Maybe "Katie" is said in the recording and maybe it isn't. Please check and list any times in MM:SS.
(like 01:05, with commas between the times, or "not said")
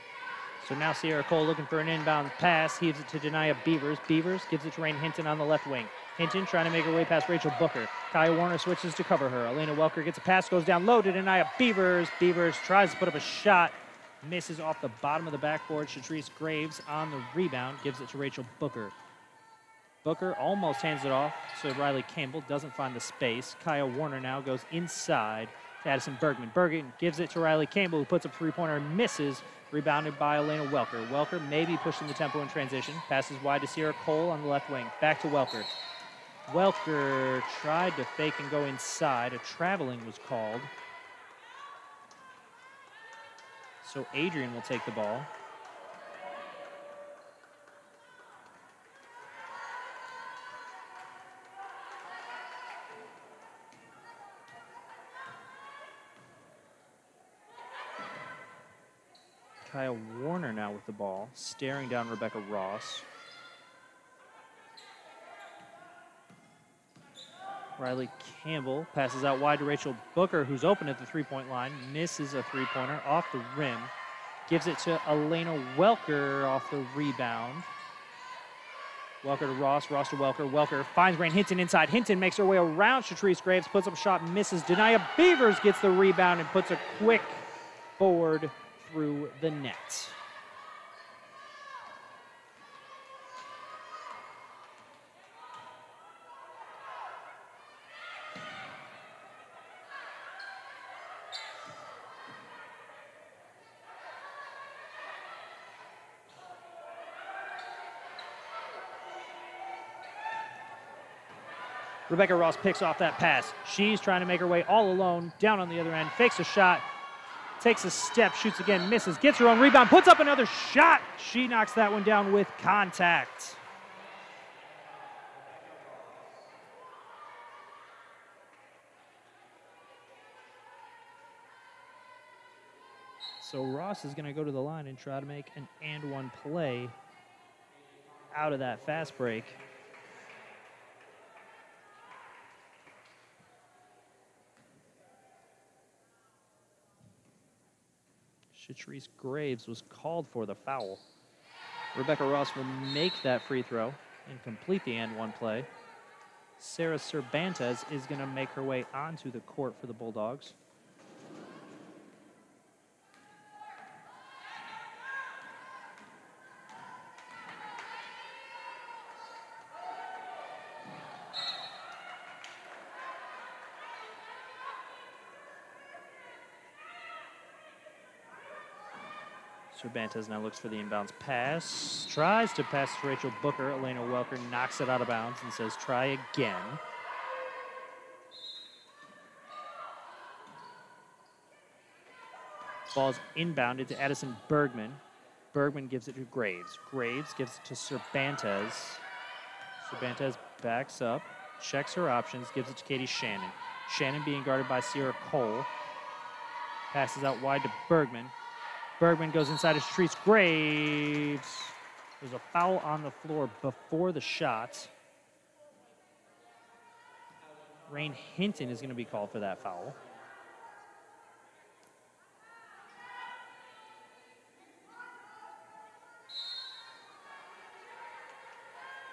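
03:22.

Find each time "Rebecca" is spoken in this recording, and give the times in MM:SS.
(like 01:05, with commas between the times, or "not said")
01:02, 01:52, 02:31.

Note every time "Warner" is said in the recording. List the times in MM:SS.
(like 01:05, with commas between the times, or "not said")
00:08, 00:23, 01:00.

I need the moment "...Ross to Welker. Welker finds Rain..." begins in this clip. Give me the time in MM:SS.
01:19.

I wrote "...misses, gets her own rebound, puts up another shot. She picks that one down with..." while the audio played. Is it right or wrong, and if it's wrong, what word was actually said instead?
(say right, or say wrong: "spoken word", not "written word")
wrong: "knocks", not "picks".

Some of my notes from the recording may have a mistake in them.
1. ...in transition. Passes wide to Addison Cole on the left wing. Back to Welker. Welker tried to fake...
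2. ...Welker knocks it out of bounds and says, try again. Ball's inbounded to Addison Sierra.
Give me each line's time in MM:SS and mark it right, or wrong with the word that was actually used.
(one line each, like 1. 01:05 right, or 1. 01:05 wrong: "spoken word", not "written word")
1. 00:32 wrong: "Sierra", not "Addison"
2. 03:03 wrong: "Bergman", not "Sierra".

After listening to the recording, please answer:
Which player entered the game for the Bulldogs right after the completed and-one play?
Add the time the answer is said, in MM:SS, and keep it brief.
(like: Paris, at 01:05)
Sarah Cervantes, at 02:36.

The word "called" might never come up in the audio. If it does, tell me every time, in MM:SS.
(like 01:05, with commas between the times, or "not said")
00:40, 02:29, 03:39.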